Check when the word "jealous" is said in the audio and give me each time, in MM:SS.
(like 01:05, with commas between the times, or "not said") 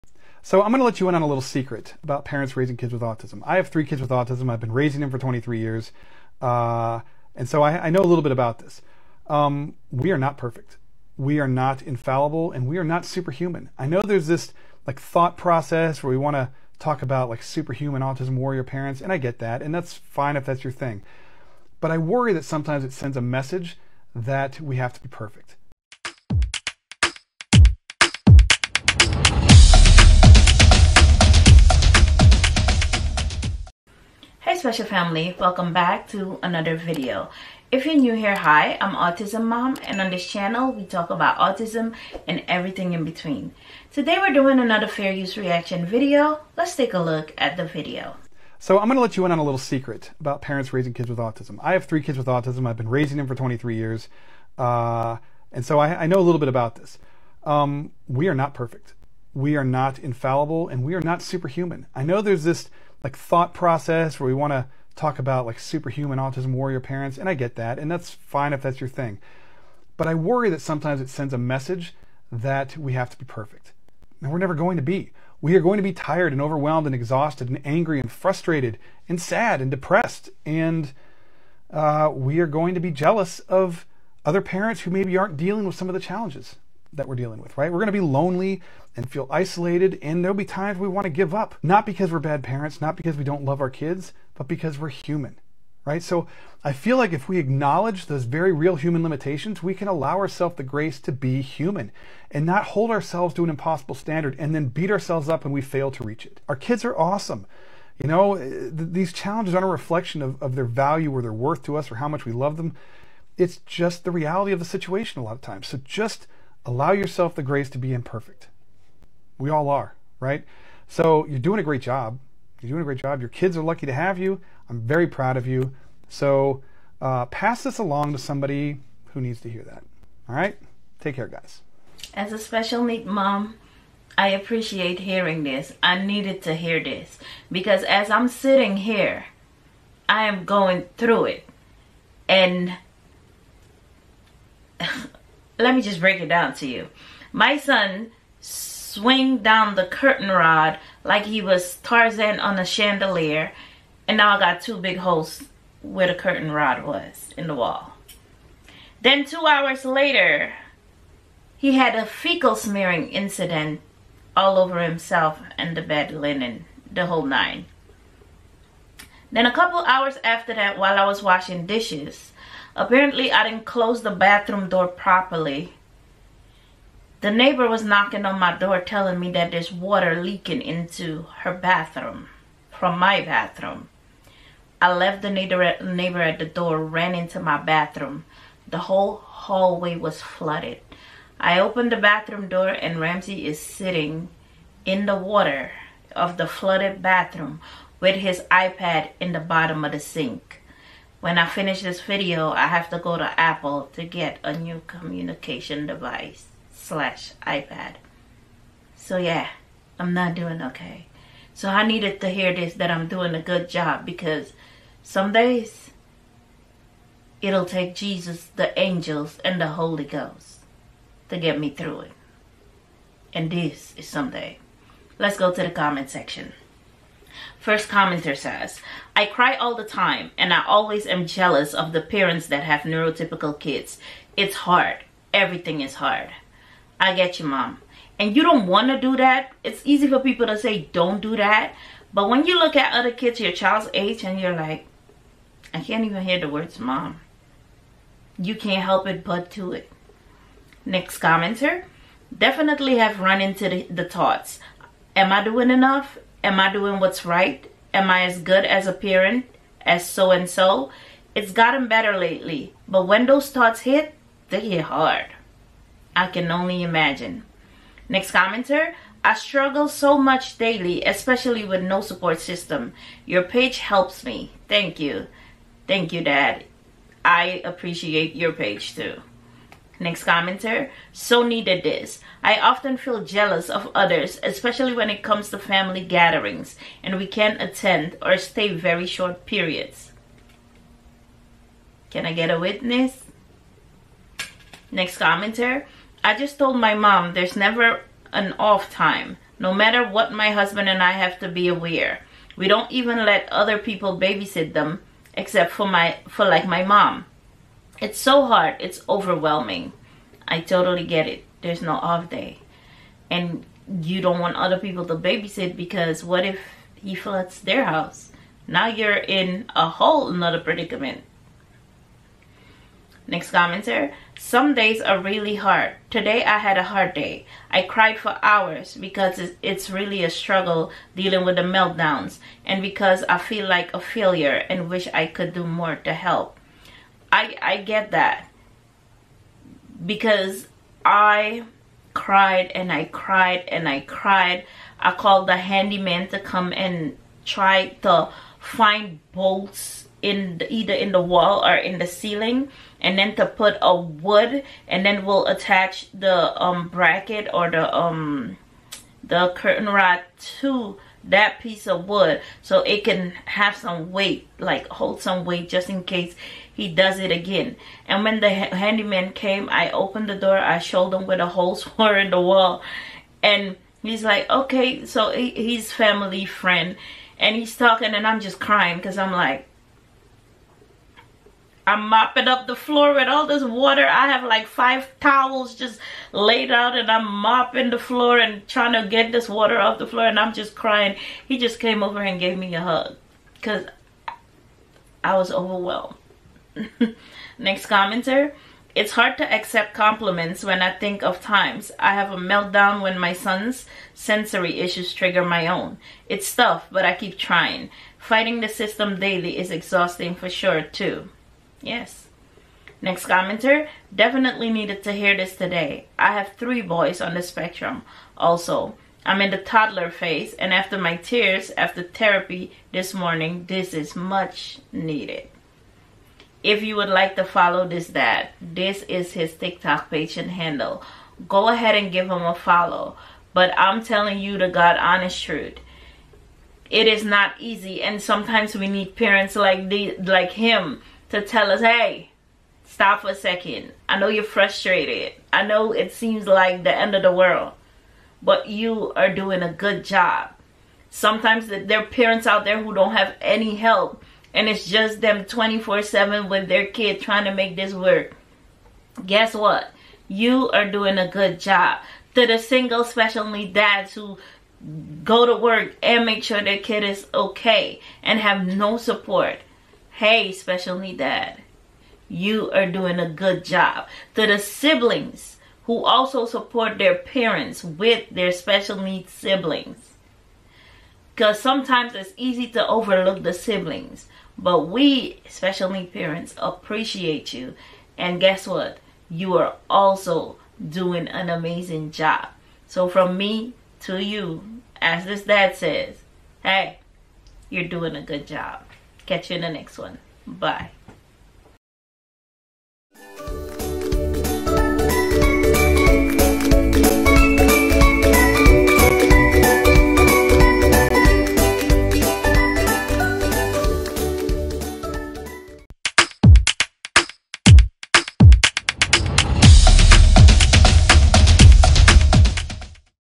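01:22, 03:51, 04:43.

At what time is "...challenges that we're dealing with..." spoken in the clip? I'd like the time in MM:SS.
01:25.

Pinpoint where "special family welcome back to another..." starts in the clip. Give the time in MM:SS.
00:34.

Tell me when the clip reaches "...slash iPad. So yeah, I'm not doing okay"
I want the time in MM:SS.
03:26.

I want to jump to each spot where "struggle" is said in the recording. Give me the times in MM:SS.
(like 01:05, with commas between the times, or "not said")
04:29, 05:30.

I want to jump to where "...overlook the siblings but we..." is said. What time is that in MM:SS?
08:02.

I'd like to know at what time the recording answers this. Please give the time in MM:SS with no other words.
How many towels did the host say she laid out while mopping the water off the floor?
06:24.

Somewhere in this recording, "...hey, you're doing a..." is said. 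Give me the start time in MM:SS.
08:16.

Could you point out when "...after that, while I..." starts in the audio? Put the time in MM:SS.
02:50.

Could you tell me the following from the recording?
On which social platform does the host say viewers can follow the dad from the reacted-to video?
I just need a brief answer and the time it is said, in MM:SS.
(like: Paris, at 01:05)
TikTok, at 07:09.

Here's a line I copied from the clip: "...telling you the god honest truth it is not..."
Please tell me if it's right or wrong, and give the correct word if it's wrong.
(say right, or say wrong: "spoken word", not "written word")
right.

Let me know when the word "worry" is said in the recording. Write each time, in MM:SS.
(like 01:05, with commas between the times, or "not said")
00:21, 01:10.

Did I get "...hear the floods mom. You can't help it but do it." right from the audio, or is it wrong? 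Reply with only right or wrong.
wrong.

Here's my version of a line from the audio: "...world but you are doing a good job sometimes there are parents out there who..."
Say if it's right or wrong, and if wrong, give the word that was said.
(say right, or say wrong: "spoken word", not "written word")
right.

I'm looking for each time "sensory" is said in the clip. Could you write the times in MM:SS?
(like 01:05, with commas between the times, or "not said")
06:44.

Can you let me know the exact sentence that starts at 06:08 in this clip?
And when the handyman came, I opened the door.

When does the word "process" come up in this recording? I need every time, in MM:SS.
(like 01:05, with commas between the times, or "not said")
00:15, 01:03.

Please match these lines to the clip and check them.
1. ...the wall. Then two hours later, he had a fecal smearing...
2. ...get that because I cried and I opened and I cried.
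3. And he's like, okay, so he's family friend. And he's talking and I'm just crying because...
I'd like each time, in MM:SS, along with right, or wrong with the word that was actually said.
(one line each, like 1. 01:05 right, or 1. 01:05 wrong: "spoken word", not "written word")
1. 02:37 right
2. 05:37 wrong: "cried", not "opened"
3. 06:13 right.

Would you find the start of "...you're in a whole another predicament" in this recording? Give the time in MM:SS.
05:18.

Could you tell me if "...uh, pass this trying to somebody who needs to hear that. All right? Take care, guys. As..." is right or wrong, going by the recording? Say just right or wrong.
wrong.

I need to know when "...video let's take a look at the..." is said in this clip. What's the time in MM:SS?
00:45.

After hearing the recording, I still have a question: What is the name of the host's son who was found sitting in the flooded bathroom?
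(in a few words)
Ramsey.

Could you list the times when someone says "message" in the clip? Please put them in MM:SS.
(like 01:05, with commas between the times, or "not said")
00:23, 01:11.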